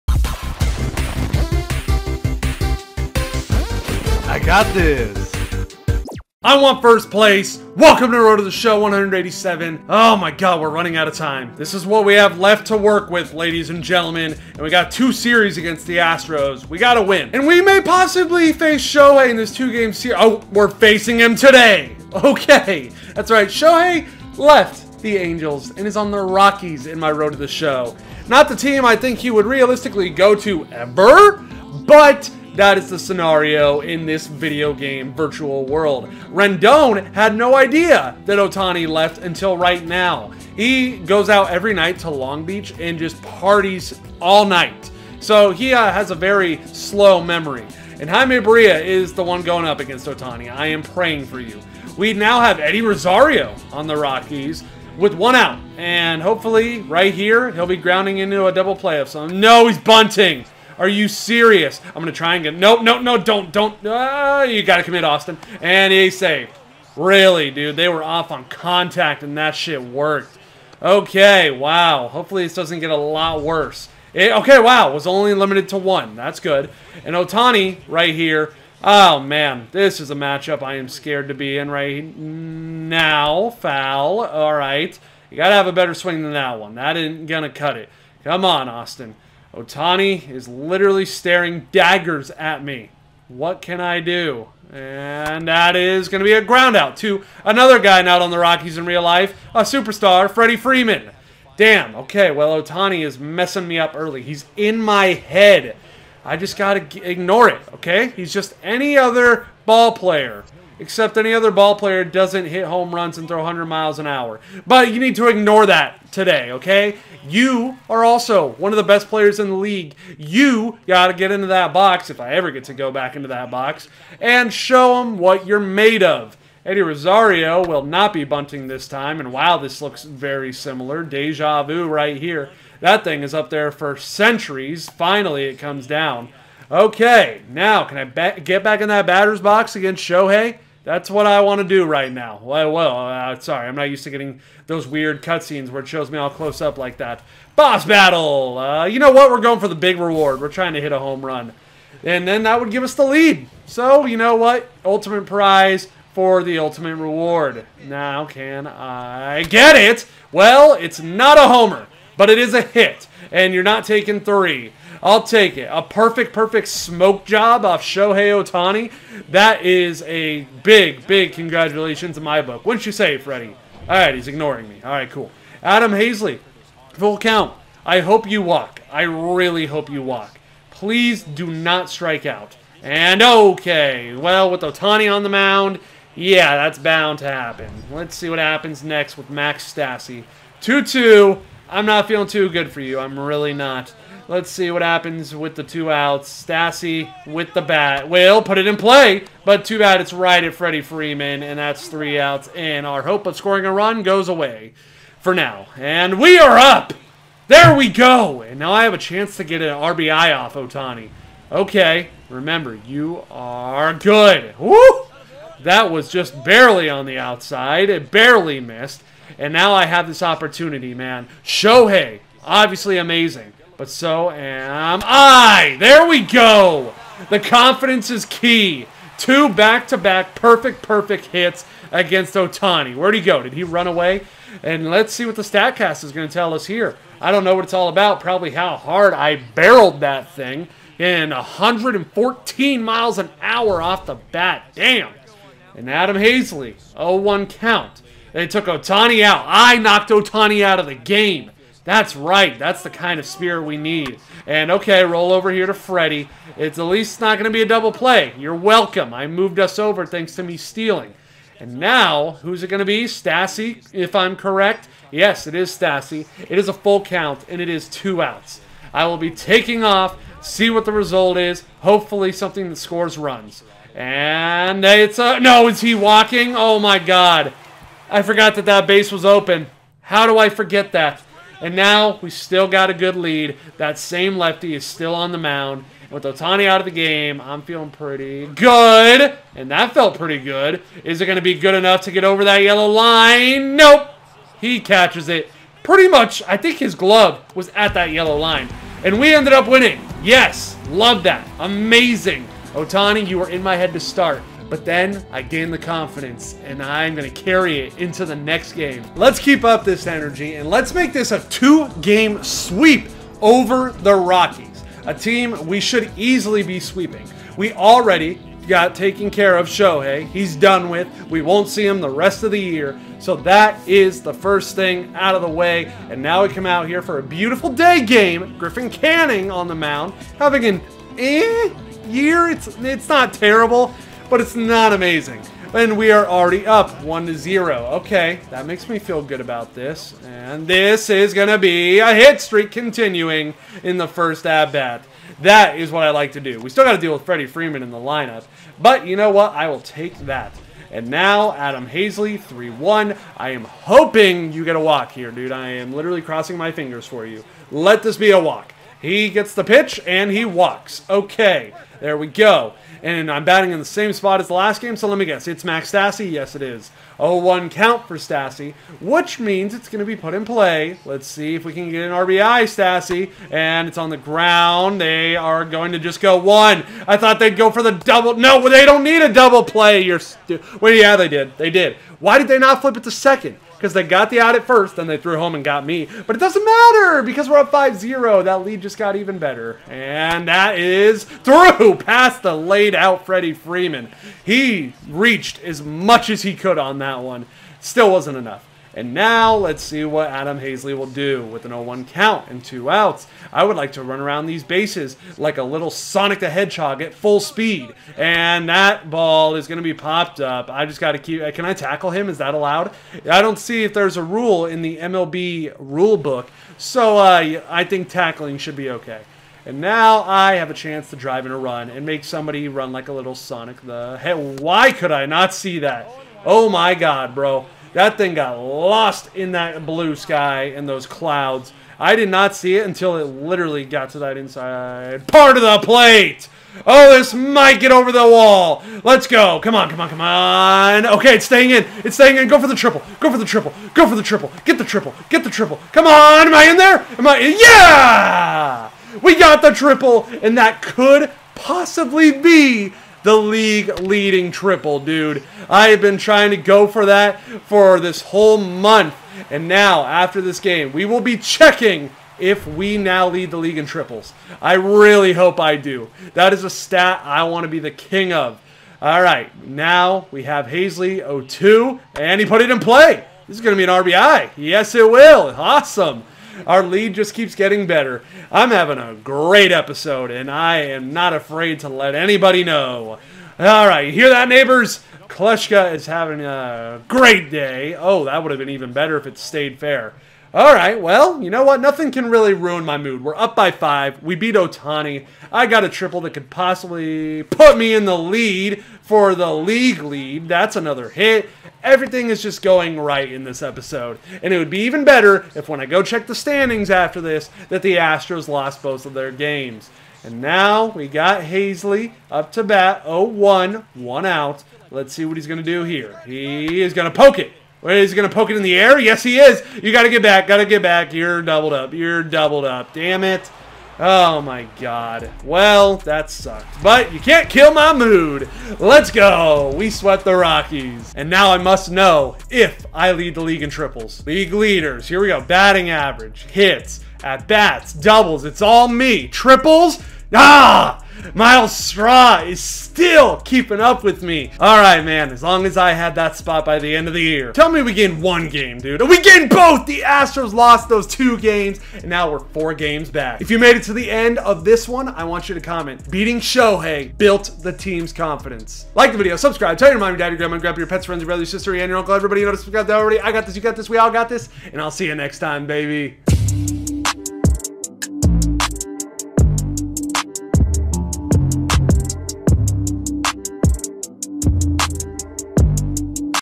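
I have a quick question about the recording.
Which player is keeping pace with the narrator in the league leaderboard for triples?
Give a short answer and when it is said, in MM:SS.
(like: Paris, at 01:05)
Myles Straw, at 09:01.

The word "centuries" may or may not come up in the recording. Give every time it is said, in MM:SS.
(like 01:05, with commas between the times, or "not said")
02:13.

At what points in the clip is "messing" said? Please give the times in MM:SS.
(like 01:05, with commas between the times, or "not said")
01:43.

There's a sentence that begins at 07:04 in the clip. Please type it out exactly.
Hey, why could I not see that?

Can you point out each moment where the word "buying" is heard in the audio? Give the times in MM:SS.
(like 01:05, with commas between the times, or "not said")
not said.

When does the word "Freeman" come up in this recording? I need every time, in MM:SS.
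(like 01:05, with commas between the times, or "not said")
01:40, 03:20, 05:47, 06:33.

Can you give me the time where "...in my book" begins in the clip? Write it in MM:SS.
02:52.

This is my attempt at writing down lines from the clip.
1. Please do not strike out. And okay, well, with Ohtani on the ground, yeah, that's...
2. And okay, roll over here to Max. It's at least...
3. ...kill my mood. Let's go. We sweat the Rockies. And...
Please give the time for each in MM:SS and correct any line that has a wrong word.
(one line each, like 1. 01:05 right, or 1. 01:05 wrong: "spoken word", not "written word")
1. 03:00 wrong: "mound", not "ground"
2. 04:14 wrong: "Freddie", not "Max"
3. 08:47 right.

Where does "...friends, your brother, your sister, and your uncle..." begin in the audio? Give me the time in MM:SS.
09:21.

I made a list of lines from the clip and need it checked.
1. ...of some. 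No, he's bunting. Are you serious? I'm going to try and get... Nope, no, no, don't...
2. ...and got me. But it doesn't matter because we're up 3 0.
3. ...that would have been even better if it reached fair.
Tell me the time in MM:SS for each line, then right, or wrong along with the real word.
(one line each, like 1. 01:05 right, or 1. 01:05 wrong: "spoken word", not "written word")
1. 00:58 right
2. 06:25 wrong: "5", not "3"
3. 08:08 wrong: "stayed", not "reached".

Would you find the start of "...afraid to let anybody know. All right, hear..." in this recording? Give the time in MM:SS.
08:01.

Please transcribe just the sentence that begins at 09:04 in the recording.
All right, man, as long as I had that spot by the end of the year.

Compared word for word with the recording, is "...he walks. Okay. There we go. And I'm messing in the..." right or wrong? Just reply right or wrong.
wrong.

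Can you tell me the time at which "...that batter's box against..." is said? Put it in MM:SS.
02:18.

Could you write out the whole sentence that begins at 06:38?
And now let's see what Adam Haseley will do with an 0-1 count and two outs.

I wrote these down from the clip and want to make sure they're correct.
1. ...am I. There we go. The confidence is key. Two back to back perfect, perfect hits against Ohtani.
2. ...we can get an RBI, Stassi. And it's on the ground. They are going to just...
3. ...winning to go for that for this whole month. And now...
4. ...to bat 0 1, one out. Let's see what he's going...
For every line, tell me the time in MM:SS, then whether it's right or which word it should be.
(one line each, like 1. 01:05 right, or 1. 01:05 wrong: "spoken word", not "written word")
1. 03:44 right
2. 06:11 right
3. 07:36 wrong: "trying", not "winning"
4. 08:32 right.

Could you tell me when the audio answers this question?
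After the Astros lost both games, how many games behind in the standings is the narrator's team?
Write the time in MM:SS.
09:12.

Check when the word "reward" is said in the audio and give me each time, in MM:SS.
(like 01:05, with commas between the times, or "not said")
02:29, 02:36.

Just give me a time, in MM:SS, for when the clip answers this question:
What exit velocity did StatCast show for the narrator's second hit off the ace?
04:01.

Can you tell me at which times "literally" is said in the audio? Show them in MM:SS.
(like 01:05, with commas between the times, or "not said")
01:30, 05:55, 07:13.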